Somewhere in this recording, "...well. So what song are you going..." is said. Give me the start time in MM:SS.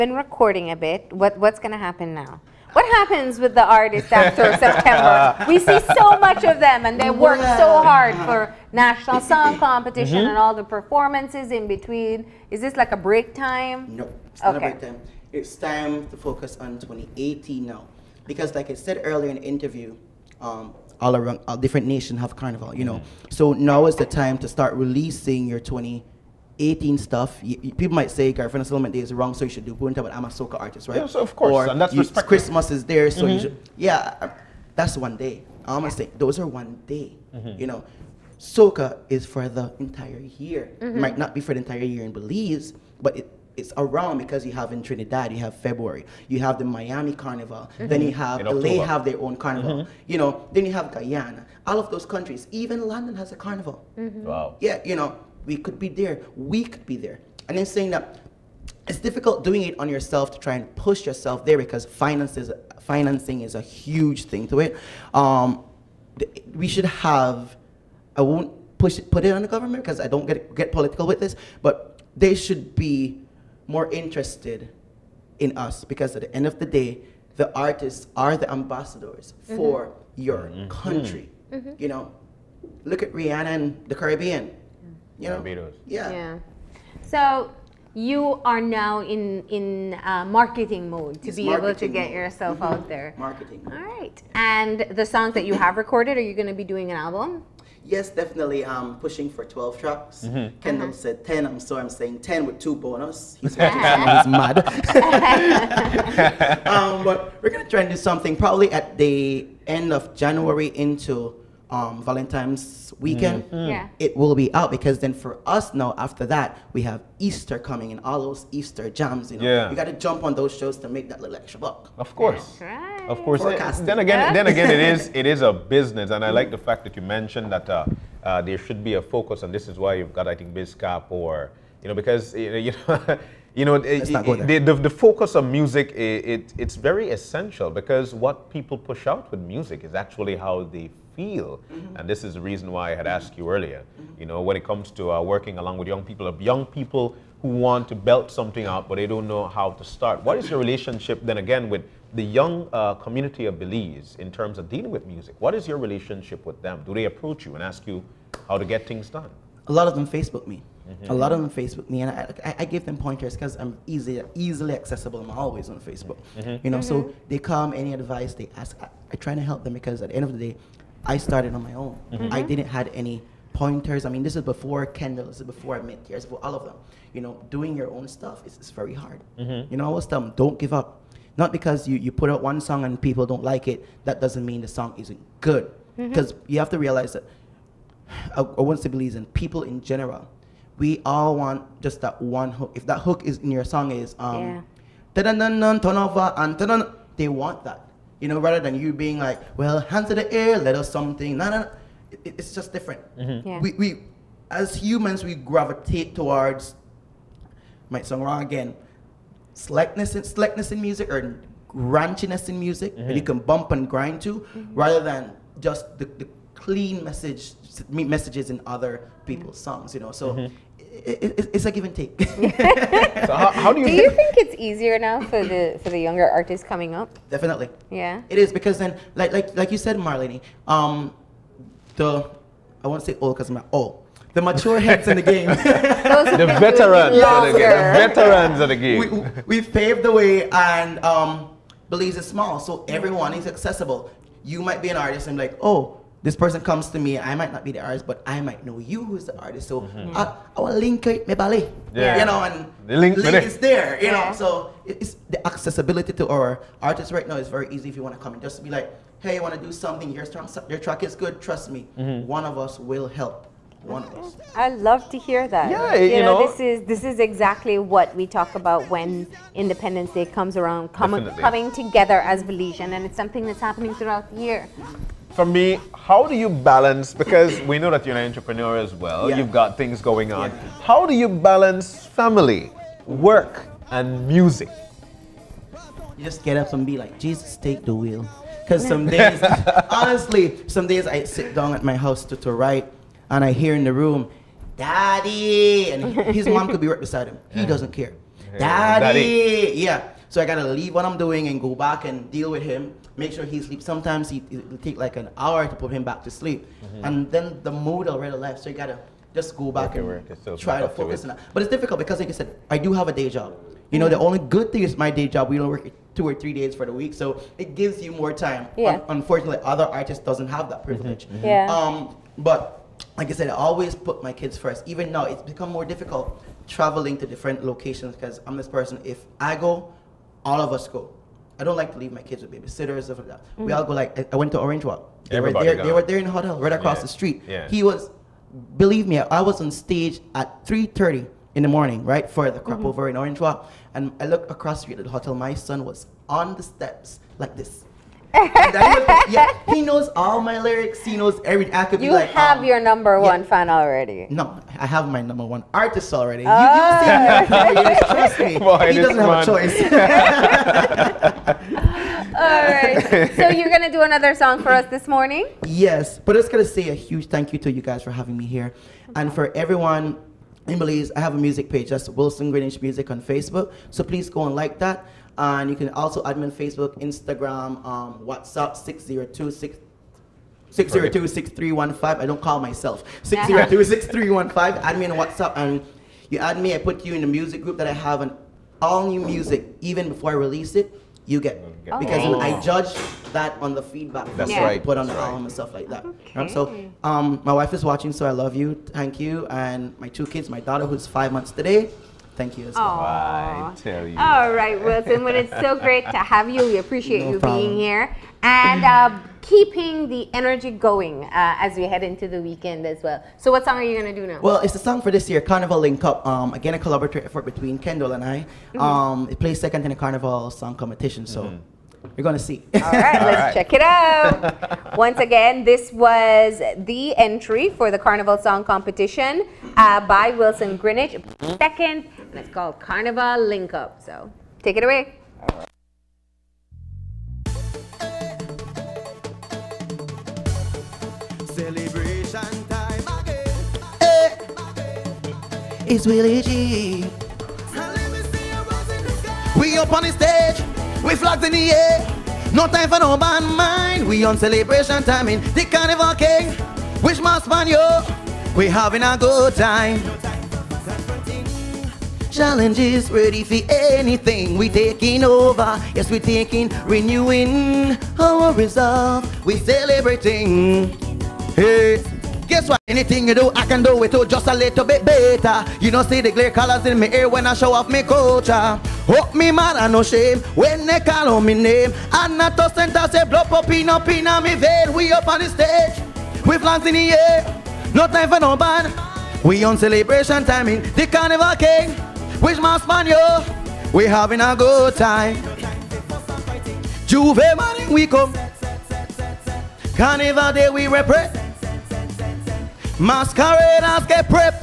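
06:53.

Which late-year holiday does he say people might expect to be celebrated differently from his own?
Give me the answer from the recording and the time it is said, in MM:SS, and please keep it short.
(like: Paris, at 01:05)
Garifuna Settlement Day, at 00:28.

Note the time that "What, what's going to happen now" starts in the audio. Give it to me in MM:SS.
00:01.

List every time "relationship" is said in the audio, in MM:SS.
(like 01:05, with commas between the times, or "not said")
02:30, 02:35.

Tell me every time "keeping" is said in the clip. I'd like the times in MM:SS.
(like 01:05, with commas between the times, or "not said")
06:49.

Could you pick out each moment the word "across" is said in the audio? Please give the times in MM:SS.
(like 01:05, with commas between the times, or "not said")
05:36, 05:44.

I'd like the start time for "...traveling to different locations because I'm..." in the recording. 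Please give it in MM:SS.
05:26.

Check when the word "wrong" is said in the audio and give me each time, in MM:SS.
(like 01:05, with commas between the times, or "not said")
00:29, 03:28.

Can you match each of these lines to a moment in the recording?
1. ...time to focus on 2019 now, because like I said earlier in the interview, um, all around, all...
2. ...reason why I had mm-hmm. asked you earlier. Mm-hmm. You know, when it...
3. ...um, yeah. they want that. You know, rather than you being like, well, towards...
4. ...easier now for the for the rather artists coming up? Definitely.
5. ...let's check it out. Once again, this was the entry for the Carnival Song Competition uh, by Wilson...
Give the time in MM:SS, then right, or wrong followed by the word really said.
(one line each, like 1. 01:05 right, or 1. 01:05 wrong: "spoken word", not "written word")
1. 00:15 wrong: "2018", not "2019"
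2. 02:22 right
3. 03:14 wrong: "hands", not "towards"
4. 03:44 wrong: "younger", not "rather"
5. 07:03 right.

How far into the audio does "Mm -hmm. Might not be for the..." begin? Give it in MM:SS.
00:40.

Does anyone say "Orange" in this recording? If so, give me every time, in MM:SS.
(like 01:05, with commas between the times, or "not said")
05:34, 05:43.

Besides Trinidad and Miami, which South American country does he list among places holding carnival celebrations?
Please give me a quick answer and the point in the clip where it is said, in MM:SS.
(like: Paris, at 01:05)
Guyana, at 00:50.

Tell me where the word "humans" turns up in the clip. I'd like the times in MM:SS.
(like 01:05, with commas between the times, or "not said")
03:24.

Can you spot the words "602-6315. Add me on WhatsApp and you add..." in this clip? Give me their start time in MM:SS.
06:23.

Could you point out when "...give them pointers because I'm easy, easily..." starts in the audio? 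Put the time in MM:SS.
02:42.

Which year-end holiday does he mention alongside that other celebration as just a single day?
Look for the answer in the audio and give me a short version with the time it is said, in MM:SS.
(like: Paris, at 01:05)
Christmas, at 00:32.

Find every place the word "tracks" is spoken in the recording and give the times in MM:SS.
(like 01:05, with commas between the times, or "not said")
01:39, 04:20.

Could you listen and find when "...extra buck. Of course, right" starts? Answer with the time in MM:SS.
02:01.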